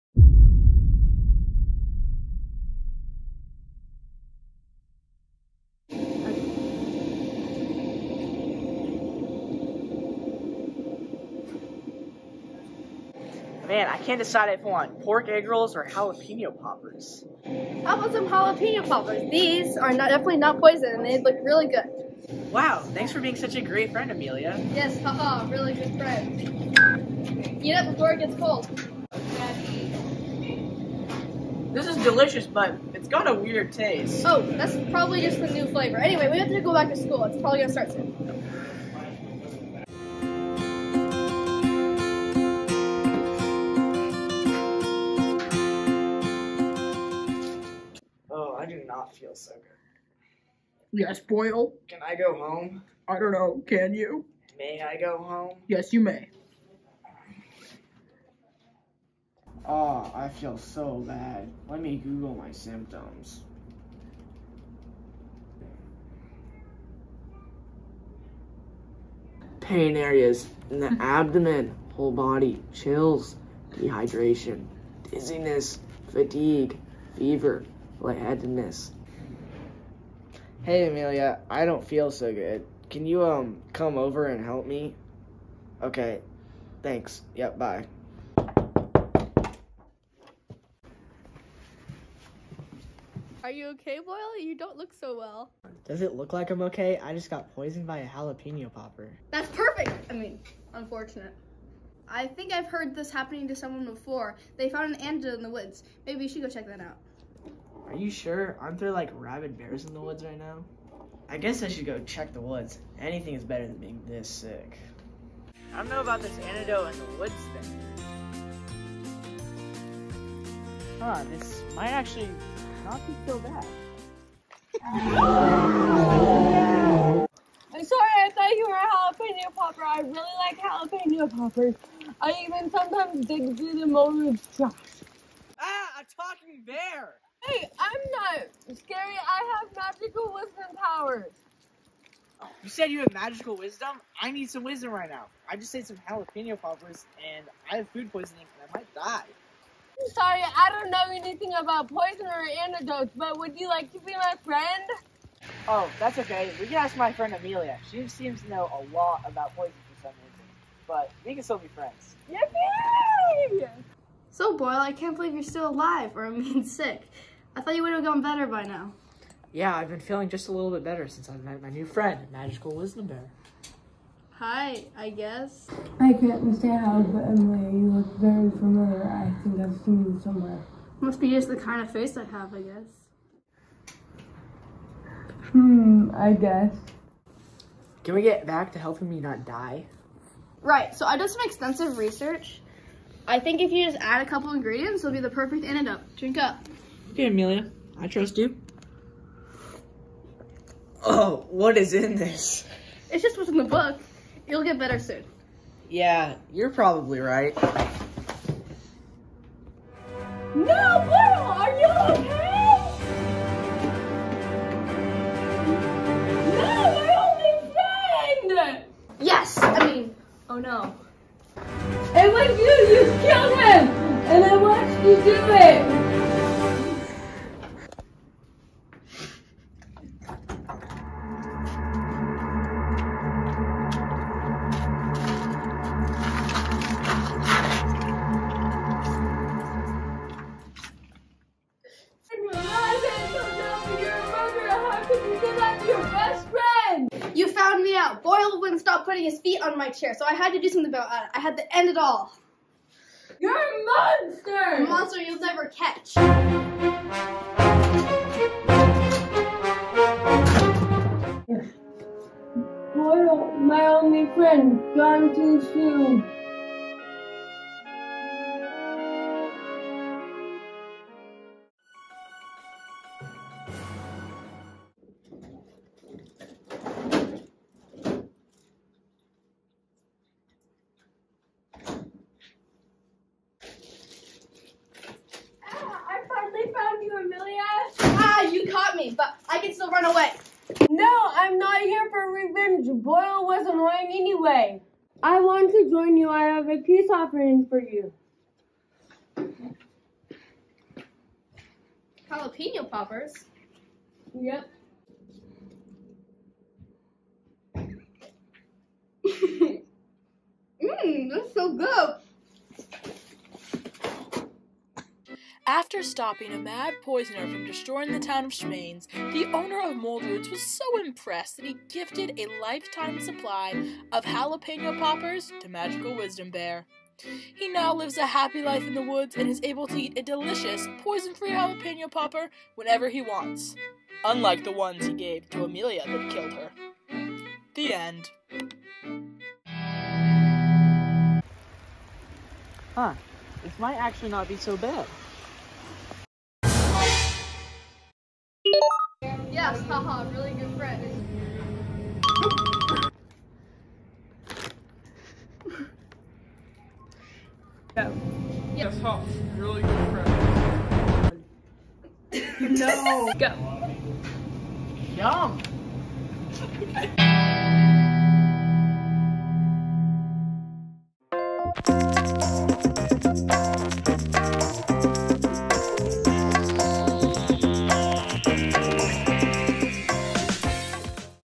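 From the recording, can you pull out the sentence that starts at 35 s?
Anyway, we have to go back to school.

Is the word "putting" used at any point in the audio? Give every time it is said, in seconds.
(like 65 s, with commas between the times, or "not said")
249 s.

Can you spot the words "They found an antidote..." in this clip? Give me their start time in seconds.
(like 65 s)
104 s.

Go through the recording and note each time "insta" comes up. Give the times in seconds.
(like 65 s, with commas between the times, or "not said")
not said.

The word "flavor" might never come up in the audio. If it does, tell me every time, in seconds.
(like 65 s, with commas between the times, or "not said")
35 s.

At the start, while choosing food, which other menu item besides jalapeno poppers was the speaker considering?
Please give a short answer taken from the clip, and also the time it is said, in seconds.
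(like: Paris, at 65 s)
pork egg rolls, at 15 s.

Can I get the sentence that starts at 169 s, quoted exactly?
Yeah, I've been feeling just a little bit better since I've met my new friend, Magical Wisdom Bear.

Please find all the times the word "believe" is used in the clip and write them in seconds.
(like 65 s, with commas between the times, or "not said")
165 s.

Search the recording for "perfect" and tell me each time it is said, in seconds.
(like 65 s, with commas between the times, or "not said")
99 s, 195 s.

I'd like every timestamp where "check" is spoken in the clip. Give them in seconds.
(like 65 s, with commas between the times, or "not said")
106 s, 112 s.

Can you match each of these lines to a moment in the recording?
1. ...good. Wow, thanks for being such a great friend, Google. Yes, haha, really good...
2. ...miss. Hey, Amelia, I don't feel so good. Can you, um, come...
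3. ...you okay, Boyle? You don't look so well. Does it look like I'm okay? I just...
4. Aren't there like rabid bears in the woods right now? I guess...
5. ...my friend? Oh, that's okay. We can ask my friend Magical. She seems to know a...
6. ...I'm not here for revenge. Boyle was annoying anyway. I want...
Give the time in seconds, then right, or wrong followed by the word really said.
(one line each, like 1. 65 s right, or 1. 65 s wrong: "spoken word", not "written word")
1. 21 s wrong: "Amelia", not "Google"
2. 78 s right
3. 93 s right
4. 108 s right
5. 154 s wrong: "Amelia", not "Magical"
6. 291 s right.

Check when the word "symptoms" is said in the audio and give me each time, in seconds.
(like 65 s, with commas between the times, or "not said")
62 s.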